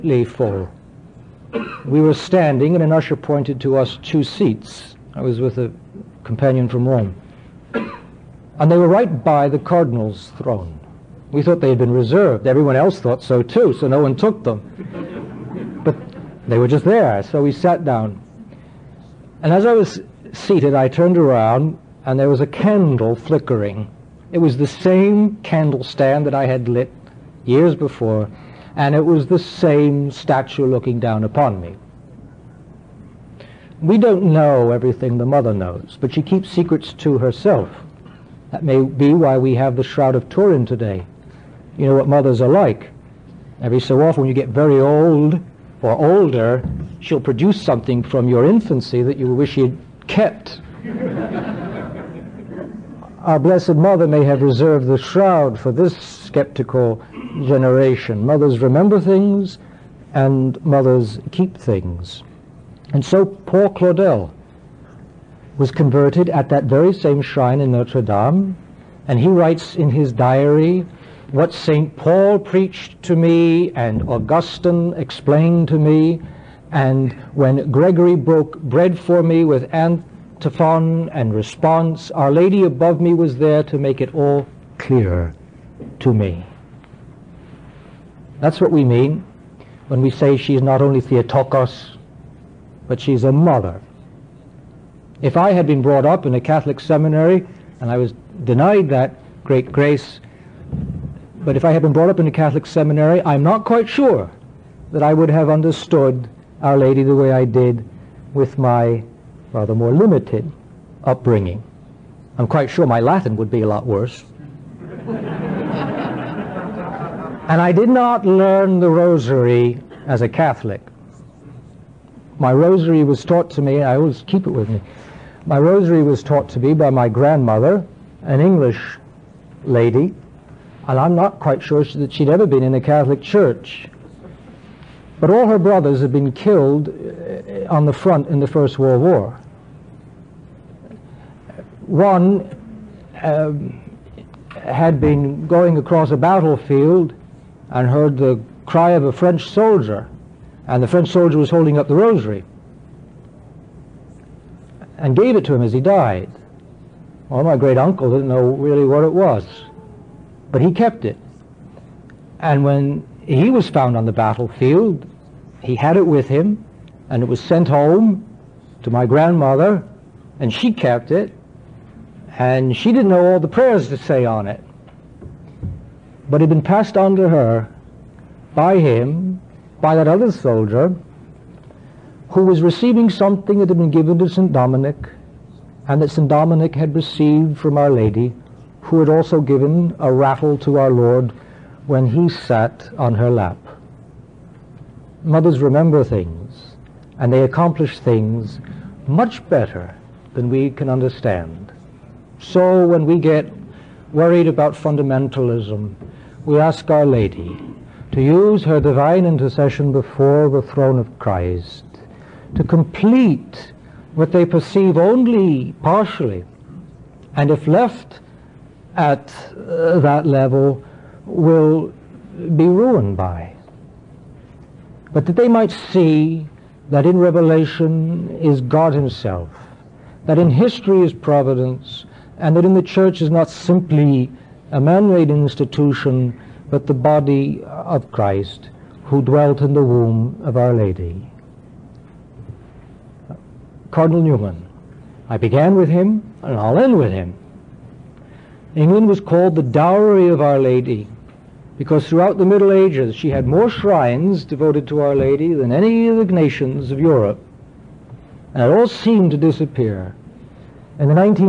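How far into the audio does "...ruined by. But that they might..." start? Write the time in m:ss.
3:42.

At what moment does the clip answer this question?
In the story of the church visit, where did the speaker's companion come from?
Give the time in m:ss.
0:06.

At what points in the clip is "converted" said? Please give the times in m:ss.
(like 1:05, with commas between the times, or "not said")
1:05.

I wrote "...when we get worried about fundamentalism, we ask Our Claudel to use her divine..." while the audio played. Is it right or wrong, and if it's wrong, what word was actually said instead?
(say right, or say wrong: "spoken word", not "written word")
wrong: "Lady", not "Claudel".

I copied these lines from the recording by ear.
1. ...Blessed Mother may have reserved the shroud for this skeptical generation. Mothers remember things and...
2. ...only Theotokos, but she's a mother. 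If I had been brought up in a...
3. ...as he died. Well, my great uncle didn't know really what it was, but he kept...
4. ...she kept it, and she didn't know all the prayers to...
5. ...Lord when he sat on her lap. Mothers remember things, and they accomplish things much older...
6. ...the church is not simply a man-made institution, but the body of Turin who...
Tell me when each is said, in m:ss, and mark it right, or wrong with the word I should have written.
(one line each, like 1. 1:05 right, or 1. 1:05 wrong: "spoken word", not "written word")
1. 0:53 right
2. 1:30 right
3. 2:35 right
4. 2:50 right
5. 3:10 wrong: "better", not "older"
6. 3:52 wrong: "Christ", not "Turin".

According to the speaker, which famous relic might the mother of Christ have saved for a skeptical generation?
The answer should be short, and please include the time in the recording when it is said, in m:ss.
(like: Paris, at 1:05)
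Shroud of Turin, at 0:39.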